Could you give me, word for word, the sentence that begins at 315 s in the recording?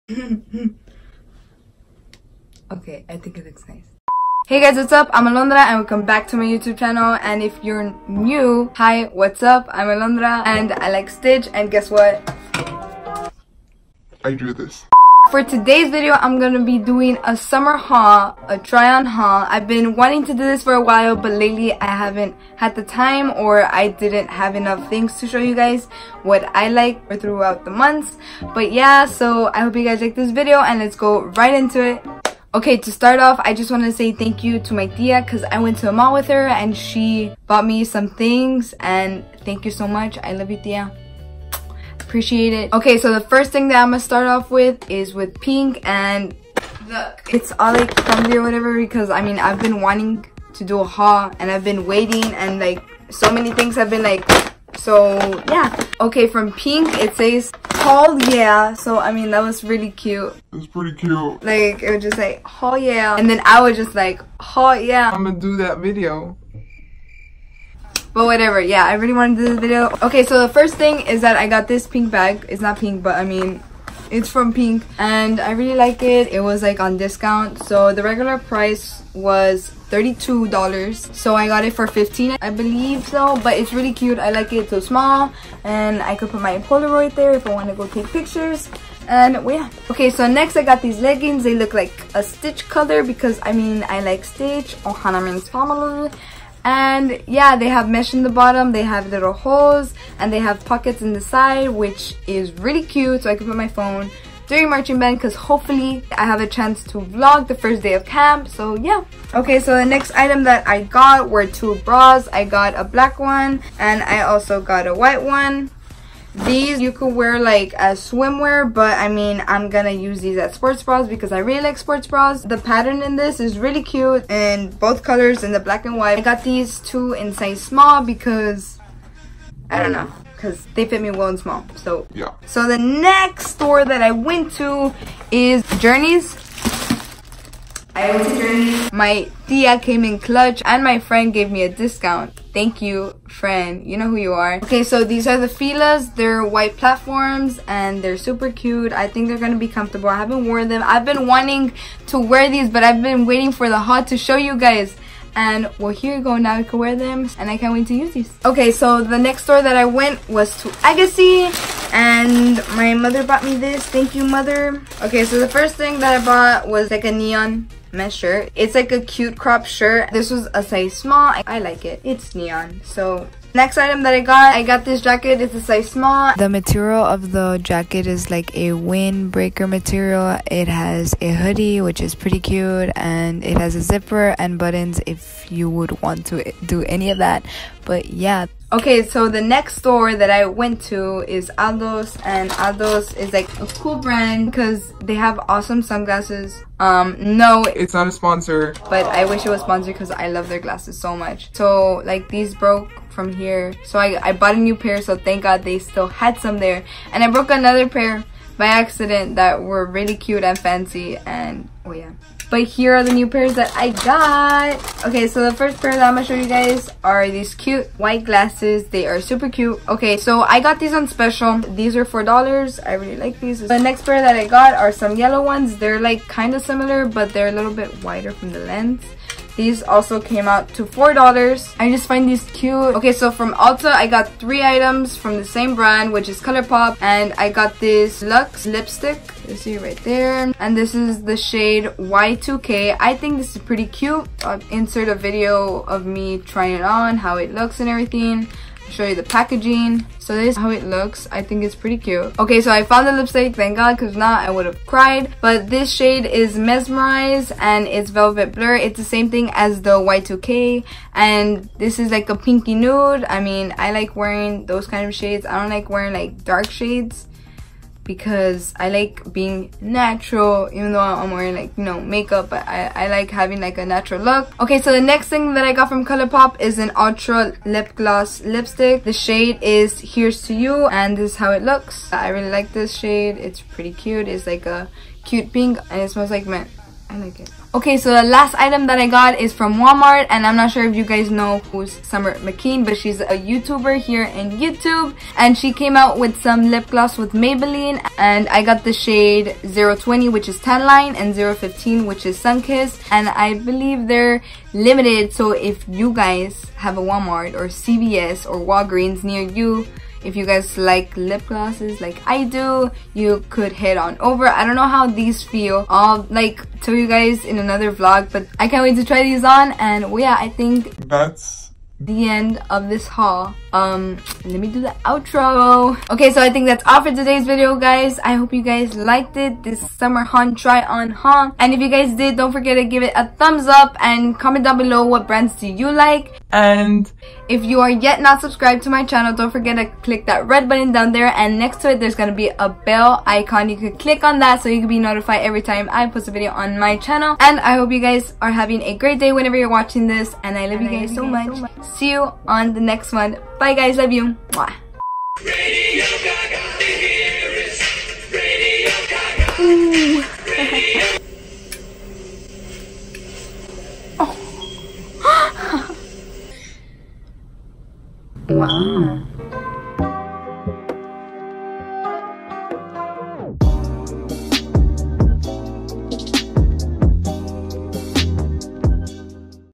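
I'll like tell you guys in another vlog, but I can't wait to try these on.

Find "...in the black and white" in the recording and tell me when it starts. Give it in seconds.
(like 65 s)
125 s.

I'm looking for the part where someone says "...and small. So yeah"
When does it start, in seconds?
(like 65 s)
131 s.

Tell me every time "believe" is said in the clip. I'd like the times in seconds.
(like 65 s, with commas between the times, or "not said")
82 s, 303 s.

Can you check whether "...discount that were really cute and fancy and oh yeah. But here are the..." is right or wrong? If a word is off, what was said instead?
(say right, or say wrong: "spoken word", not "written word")
wrong: "accident", not "discount".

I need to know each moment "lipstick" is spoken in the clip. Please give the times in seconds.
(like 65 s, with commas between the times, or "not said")
238 s, 253 s, 278 s.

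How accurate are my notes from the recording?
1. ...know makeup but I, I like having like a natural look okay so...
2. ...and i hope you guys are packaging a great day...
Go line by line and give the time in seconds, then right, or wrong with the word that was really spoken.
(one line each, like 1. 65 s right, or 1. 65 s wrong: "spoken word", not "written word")
1. 271 s right
2. 347 s wrong: "having", not "packaging".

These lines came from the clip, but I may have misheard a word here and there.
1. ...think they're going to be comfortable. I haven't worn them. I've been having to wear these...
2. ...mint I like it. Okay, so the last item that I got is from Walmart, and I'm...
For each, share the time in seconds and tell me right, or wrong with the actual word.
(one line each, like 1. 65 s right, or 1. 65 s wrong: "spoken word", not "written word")
1. 149 s wrong: "wanting", not "having"
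2. 286 s right.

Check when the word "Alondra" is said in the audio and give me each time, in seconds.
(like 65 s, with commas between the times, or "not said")
5 s, 9 s.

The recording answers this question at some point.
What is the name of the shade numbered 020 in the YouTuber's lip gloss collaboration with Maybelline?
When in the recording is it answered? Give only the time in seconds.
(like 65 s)
300 s.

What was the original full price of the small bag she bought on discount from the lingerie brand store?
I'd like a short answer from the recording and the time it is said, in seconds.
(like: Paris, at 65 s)
$32, at 79 s.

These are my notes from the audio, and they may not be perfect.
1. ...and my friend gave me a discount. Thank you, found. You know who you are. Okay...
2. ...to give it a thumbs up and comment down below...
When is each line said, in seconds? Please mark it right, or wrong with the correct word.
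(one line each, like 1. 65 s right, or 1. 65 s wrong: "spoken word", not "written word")
1. 140 s wrong: "friend", not "found"
2. 332 s right.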